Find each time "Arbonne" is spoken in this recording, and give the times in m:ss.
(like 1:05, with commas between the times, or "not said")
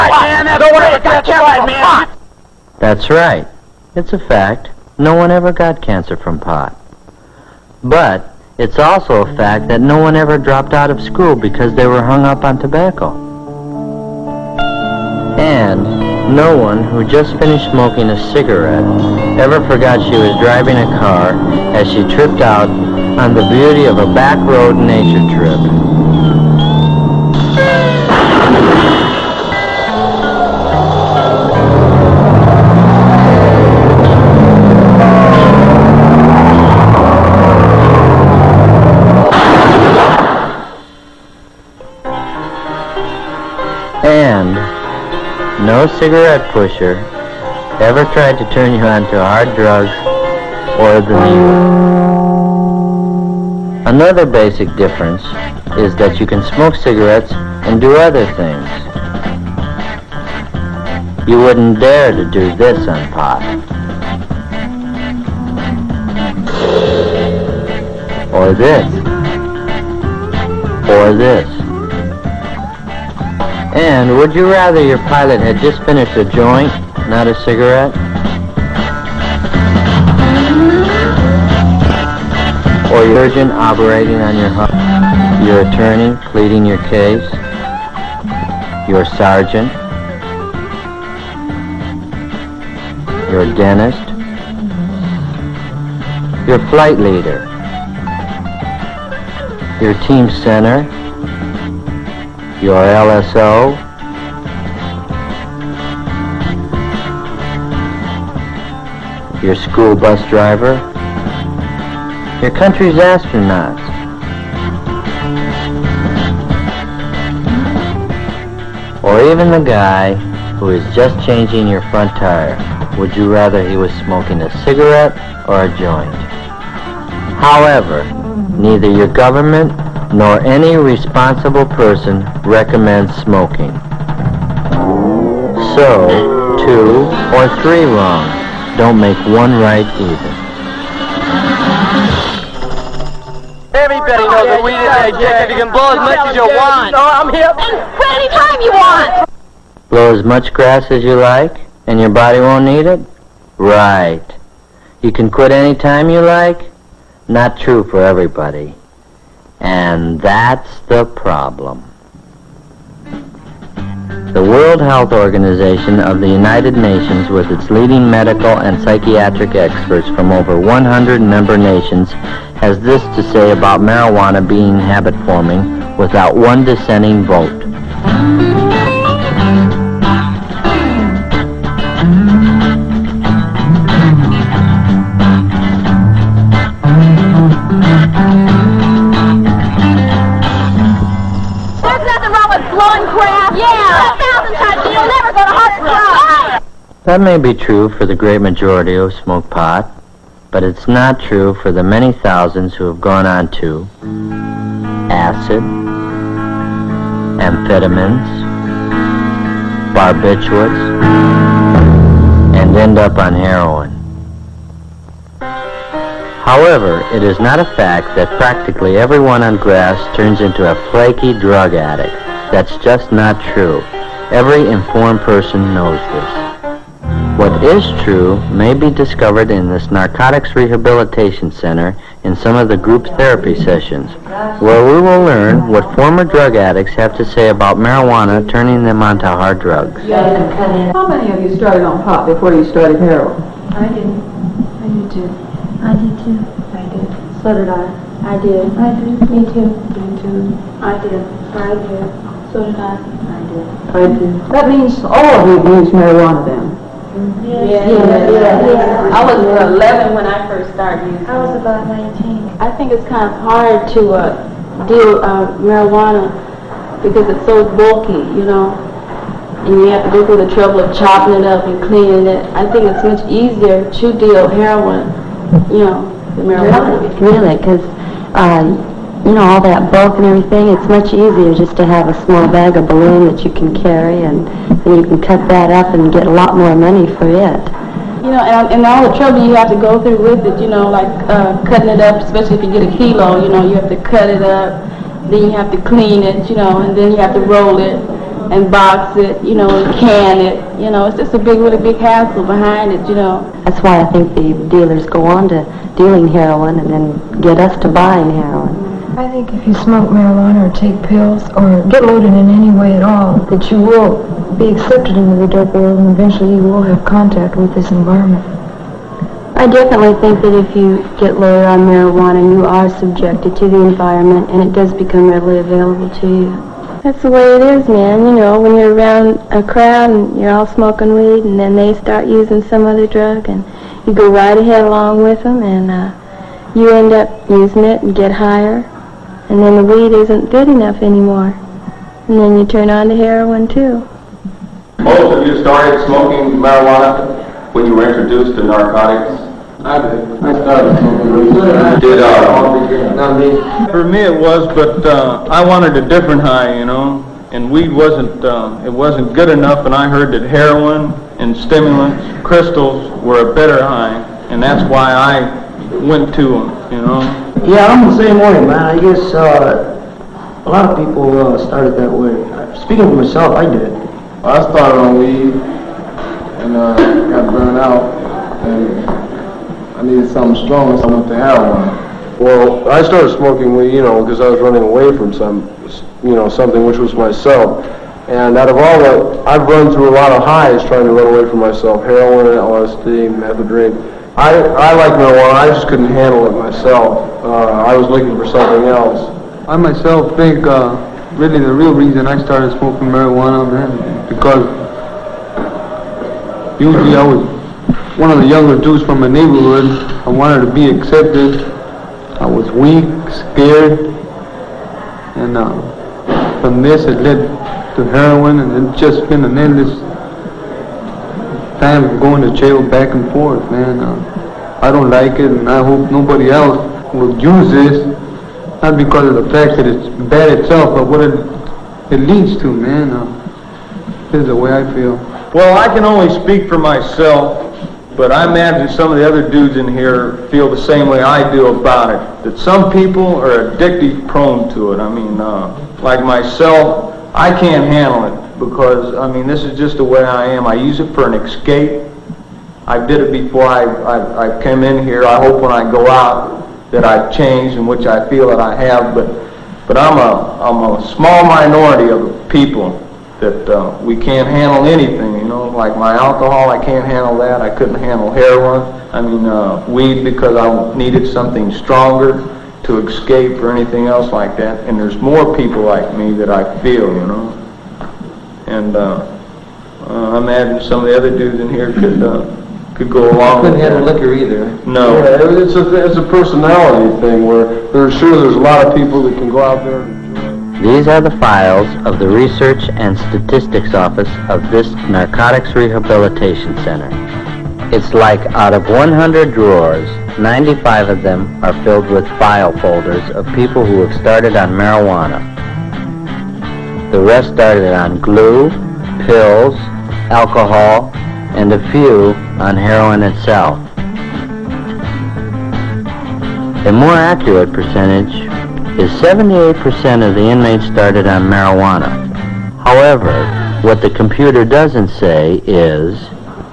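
not said.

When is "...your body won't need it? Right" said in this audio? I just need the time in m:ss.
2:31.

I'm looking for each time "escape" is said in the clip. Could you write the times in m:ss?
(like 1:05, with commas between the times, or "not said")
7:31, 7:53.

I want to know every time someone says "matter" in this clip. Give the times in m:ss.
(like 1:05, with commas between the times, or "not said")
not said.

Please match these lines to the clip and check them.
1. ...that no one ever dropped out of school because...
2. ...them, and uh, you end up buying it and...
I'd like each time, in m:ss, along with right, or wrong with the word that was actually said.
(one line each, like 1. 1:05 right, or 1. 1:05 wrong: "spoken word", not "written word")
1. 0:09 right
2. 5:35 wrong: "using", not "buying".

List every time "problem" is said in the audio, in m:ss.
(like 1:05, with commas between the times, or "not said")
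2:41.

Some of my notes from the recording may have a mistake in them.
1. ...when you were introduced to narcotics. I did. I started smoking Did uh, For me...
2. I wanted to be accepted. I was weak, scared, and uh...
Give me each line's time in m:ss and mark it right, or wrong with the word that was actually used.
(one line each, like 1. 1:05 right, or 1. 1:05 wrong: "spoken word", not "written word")
1. 5:47 right
2. 6:50 right.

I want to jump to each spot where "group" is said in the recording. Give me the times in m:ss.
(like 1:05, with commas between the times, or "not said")
3:52.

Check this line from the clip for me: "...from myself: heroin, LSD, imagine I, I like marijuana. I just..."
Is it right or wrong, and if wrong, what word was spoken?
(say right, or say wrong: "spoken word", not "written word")
wrong: "methadone", not "imagine".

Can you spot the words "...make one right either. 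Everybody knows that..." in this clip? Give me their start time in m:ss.
2:18.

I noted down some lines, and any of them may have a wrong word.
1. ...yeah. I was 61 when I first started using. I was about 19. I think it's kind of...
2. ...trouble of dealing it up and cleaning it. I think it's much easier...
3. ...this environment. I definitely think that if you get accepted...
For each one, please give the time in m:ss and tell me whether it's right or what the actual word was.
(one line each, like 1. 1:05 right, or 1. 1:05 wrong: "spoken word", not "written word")
1. 4:18 wrong: "11", not "61"
2. 4:30 wrong: "chopping", not "dealing"
3. 5:17 wrong: "loaded", not "accepted".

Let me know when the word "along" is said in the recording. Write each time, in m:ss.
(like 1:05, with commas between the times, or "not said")
5:34, 8:03.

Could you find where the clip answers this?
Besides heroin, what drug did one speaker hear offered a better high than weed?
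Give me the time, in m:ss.
6:02.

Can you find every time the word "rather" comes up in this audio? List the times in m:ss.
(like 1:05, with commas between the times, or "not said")
1:14, 2:03.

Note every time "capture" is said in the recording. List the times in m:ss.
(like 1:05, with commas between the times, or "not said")
not said.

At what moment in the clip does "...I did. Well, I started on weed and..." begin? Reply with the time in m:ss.
6:13.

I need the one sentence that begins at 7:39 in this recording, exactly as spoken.
But but I'm a I'm a small minority of people that uh, we can't handle anything.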